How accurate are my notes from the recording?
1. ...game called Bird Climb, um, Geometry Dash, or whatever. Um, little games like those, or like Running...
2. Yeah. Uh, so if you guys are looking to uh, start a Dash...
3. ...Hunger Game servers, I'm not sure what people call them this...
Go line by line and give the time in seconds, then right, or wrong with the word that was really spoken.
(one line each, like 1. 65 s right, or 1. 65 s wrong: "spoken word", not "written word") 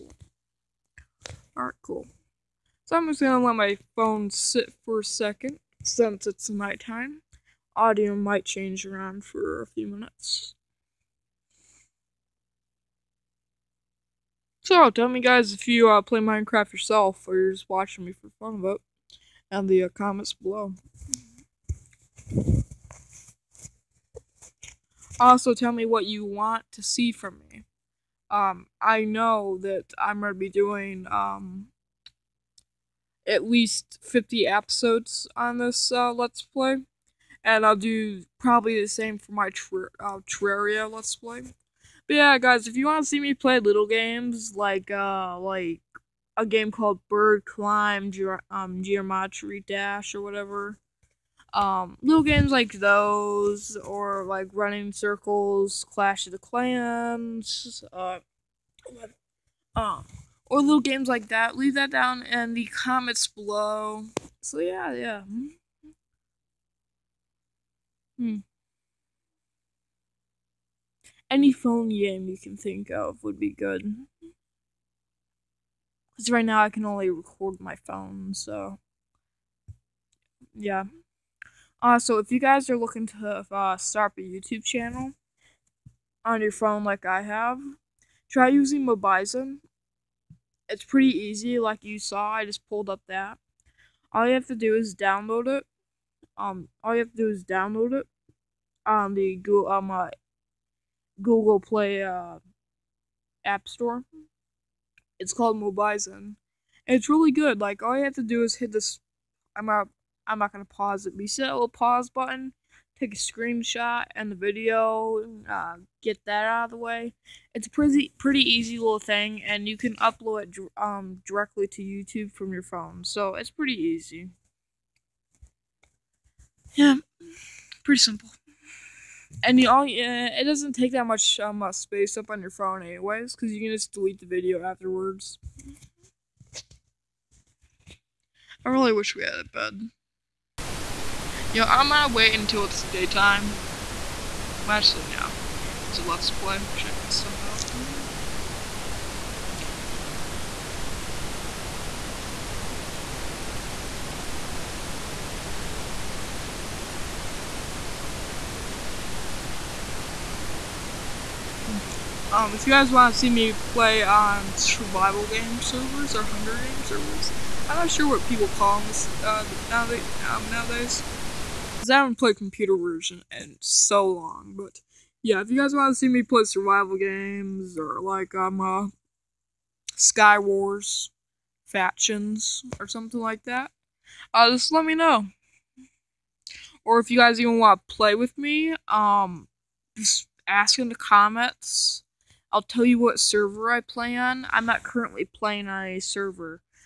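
1. 46 s right
2. 80 s wrong: "YouTube", not "Dash"
3. 166 s right.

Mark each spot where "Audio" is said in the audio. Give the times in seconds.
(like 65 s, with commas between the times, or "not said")
7 s.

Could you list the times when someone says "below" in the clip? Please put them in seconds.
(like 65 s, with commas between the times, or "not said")
20 s, 63 s.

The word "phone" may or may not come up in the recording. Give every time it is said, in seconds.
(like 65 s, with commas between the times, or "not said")
3 s, 71 s, 77 s, 86 s, 122 s, 132 s.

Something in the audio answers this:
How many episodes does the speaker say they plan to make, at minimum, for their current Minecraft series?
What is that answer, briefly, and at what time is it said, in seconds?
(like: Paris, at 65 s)
50, at 34 s.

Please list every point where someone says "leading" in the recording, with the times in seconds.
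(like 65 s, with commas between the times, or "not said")
not said.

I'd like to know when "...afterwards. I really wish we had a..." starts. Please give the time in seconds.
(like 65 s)
134 s.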